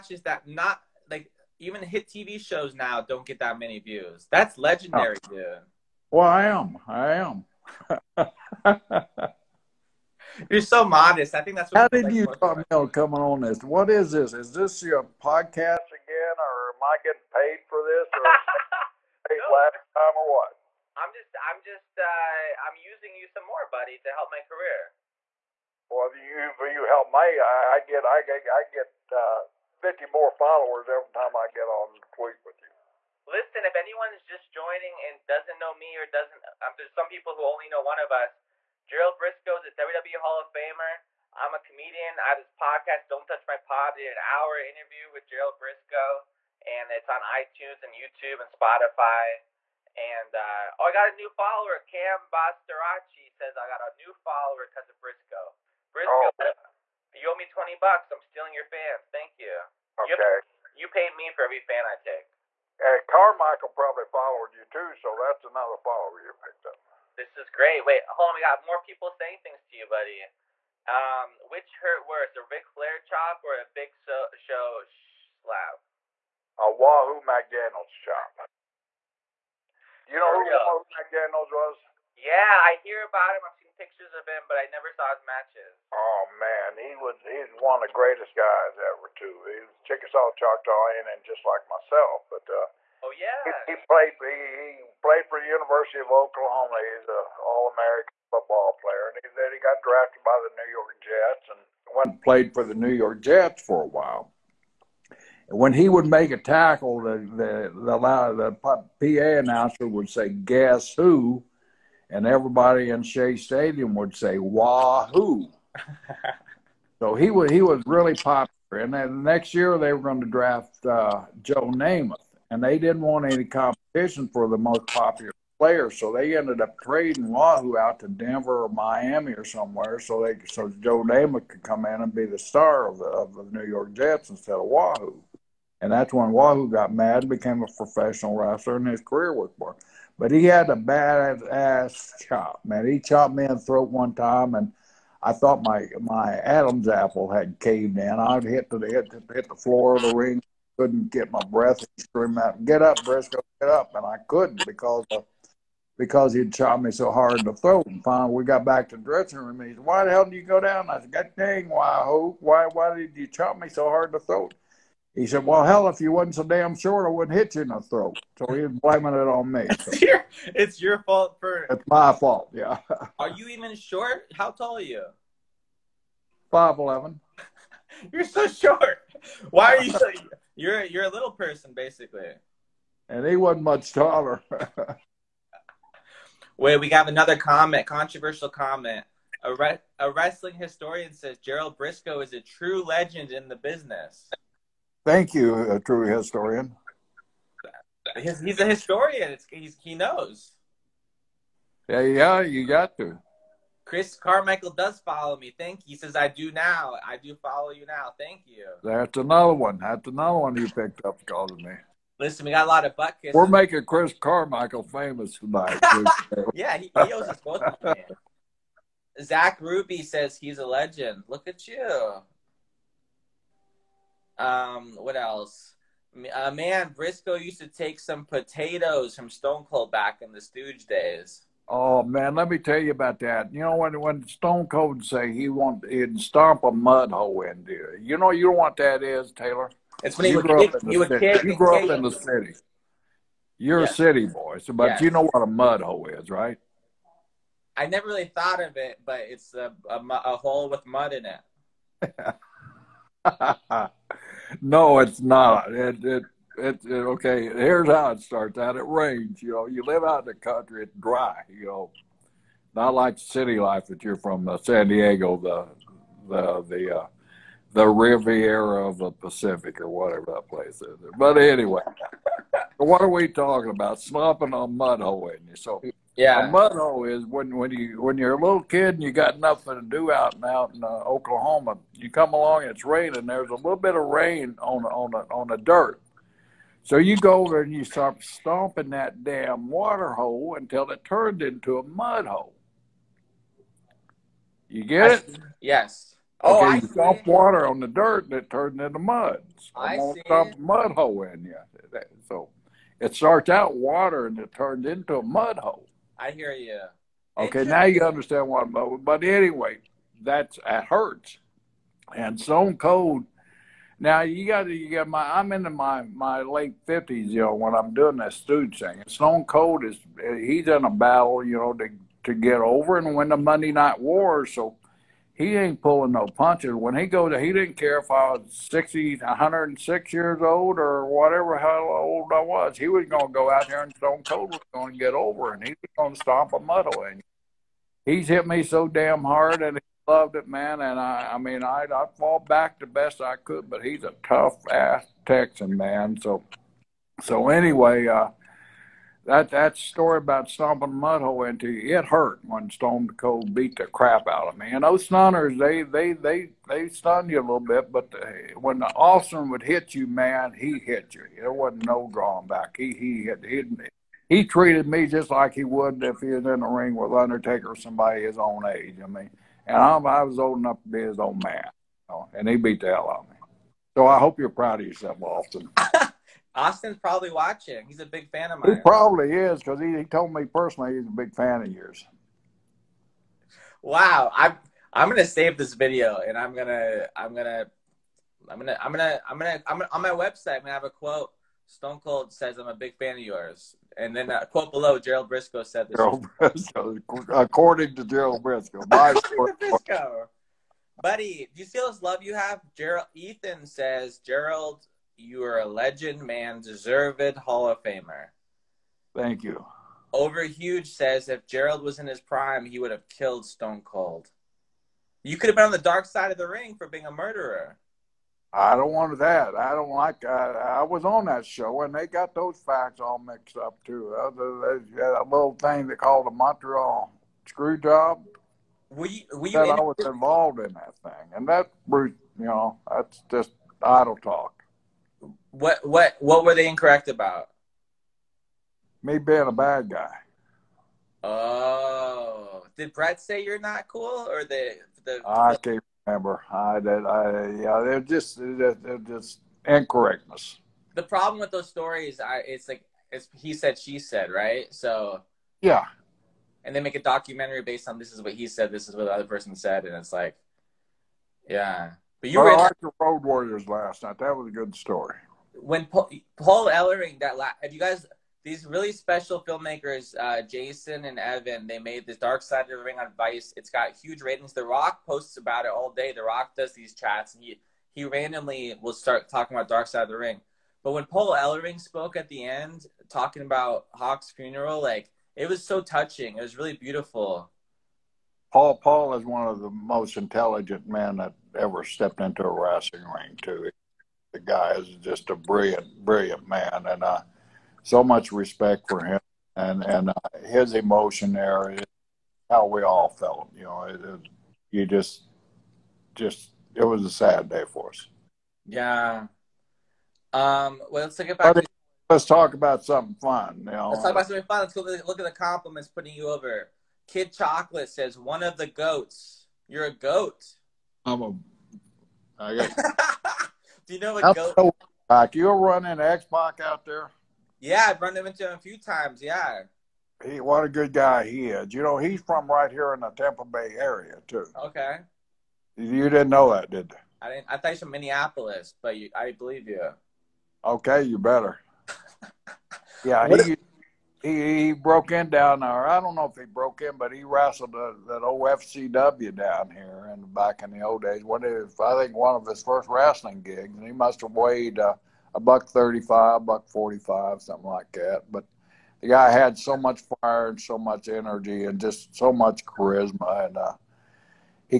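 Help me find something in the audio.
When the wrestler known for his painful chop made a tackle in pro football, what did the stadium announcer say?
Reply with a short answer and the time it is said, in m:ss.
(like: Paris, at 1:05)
Guess who?, at 1:50.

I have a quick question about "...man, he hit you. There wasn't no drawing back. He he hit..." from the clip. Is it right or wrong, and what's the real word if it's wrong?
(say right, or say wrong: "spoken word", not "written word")
right.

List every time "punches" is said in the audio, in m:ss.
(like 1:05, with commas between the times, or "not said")
5:26.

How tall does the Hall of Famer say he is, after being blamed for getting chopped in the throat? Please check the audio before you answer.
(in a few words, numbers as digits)
5'11".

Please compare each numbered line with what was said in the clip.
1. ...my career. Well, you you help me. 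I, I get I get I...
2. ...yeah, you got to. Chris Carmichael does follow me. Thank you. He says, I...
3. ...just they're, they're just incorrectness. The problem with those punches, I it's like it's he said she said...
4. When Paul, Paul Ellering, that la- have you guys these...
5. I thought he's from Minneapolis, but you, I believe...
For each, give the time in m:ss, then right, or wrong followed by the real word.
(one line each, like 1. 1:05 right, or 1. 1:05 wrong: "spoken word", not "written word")
1. 0:24 right
2. 3:22 right
3. 7:27 wrong: "stories", not "punches"
4. 7:45 right
5. 8:57 right.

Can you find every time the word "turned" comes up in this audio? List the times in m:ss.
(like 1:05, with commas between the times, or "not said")
4:51, 4:58, 5:04.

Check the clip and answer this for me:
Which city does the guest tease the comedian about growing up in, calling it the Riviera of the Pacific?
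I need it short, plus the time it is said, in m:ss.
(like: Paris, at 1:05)
San Diego, at 4:24.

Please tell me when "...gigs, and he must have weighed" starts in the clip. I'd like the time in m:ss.
9:13.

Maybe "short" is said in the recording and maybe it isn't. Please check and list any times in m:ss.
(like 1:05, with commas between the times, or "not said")
2:46, 2:53, 2:58.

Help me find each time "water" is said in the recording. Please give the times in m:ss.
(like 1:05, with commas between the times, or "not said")
4:49, 4:57, 5:03.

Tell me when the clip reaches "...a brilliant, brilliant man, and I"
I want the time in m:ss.
8:15.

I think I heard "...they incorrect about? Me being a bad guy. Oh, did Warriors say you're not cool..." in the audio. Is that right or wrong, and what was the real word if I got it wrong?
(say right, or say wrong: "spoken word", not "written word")
wrong: "Brett", not "Warriors".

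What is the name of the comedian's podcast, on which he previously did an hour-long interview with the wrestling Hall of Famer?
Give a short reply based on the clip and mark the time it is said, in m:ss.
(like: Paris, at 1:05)
Don't Touch My Pod, at 0:43.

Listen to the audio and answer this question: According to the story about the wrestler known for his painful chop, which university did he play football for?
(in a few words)
University of Oklahoma.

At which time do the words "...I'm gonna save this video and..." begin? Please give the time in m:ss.
6:24.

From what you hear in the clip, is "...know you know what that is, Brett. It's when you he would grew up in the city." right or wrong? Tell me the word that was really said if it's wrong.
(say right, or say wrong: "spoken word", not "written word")
wrong: "Taylor", not "Brett".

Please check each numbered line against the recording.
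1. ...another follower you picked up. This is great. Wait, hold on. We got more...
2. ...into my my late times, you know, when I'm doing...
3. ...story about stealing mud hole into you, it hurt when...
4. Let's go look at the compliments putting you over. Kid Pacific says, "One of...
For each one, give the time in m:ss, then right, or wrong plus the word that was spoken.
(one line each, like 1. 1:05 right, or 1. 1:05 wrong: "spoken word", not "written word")
1. 1:05 right
2. 5:15 wrong: "fifties", not "times"
3. 5:49 wrong: "stomping", not "stealing"
4. 8:34 wrong: "Chocolate", not "Pacific".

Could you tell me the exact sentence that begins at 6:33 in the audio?
And then a uh, quote below, Gerald Brisco said this.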